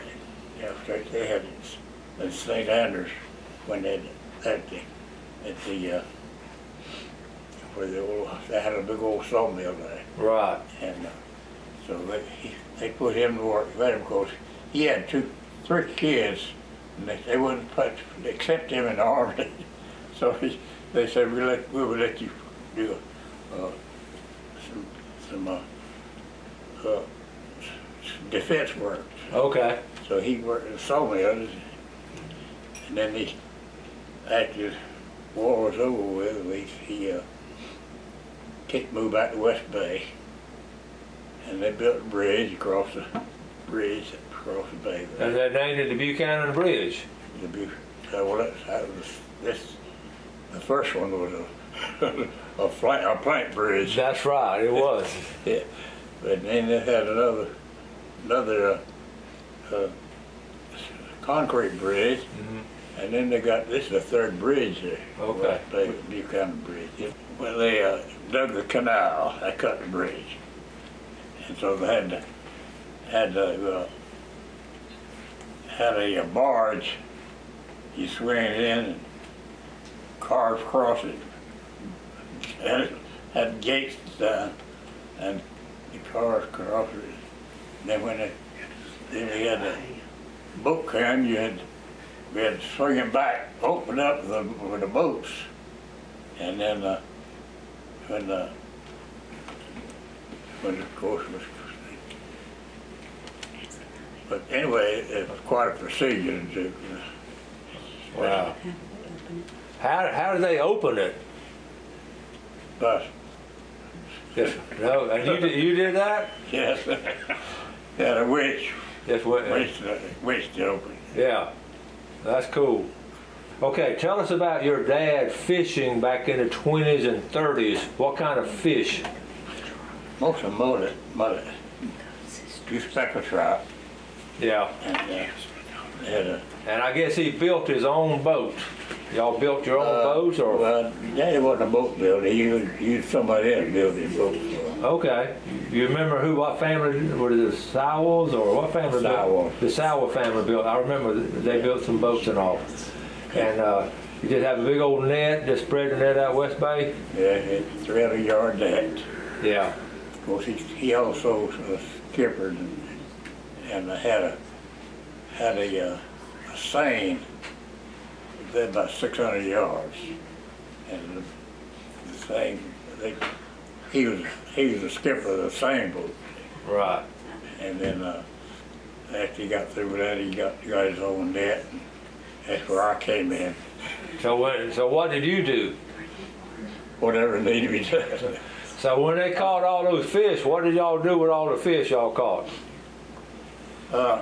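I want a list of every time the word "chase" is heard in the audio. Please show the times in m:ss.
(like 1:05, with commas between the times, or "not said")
not said.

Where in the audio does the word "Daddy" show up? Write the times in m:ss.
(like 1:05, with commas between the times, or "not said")
2:21.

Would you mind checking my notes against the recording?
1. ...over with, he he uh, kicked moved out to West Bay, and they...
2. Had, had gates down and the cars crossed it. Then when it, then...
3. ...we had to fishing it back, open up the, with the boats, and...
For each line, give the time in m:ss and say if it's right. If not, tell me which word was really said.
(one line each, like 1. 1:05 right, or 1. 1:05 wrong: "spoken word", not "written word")
1. 0:35 right
2. 1:22 right
3. 1:32 wrong: "swing", not "fishing".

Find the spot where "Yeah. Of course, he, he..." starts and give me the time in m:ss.
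2:39.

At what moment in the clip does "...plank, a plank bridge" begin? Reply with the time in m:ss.
0:52.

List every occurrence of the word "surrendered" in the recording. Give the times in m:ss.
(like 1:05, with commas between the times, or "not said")
not said.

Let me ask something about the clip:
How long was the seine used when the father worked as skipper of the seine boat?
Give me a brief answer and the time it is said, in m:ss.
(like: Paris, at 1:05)
600 yards, at 2:48.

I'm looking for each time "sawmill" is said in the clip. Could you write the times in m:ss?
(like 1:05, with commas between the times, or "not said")
0:09, 0:30.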